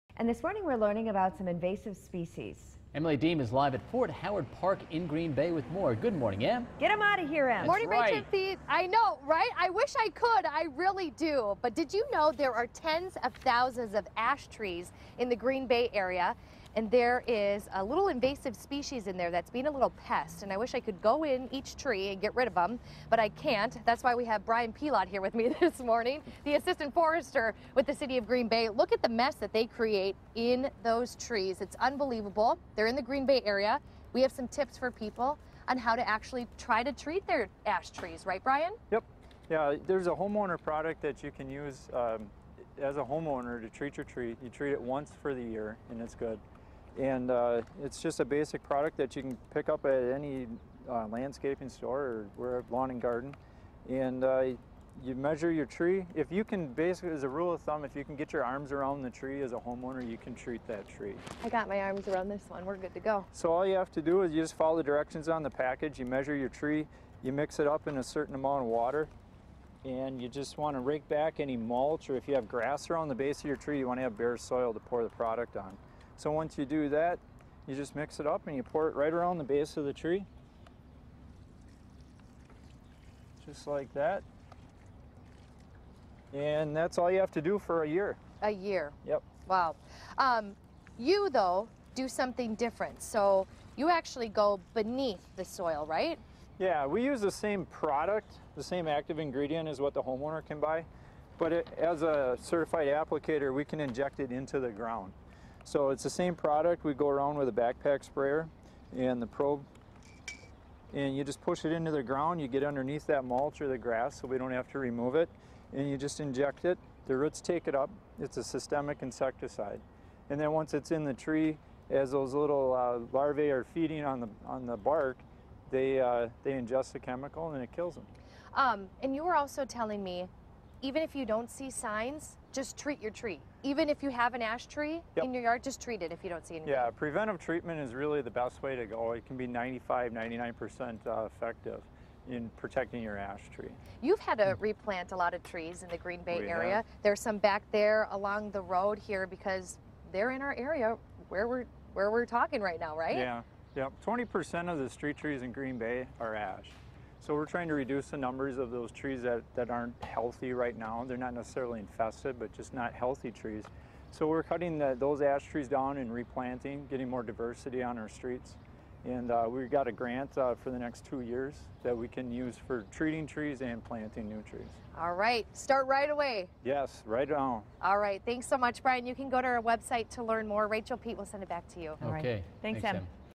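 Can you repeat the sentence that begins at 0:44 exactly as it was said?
You treat it once for the year, and it's good.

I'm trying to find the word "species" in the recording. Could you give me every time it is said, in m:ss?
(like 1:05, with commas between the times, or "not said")
0:01, 0:18.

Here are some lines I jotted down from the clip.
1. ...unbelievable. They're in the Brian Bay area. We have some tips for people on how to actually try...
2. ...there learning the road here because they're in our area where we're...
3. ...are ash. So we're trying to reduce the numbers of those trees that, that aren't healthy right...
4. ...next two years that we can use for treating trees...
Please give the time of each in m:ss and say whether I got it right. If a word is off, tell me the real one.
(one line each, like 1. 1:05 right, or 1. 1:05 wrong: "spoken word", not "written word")
1. 0:31 wrong: "Green", not "Brian"
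2. 2:27 wrong: "along", not "learning"
3. 2:36 right
4. 2:50 right.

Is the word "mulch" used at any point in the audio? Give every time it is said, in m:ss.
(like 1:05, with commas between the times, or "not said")
1:11, 1:53.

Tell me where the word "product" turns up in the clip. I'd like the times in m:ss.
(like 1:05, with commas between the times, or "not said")
0:40, 0:48, 1:15, 1:37, 1:46.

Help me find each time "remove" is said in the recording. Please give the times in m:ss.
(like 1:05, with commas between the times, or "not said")
1:54.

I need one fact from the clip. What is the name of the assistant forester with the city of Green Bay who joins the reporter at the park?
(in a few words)
Brian Pilot.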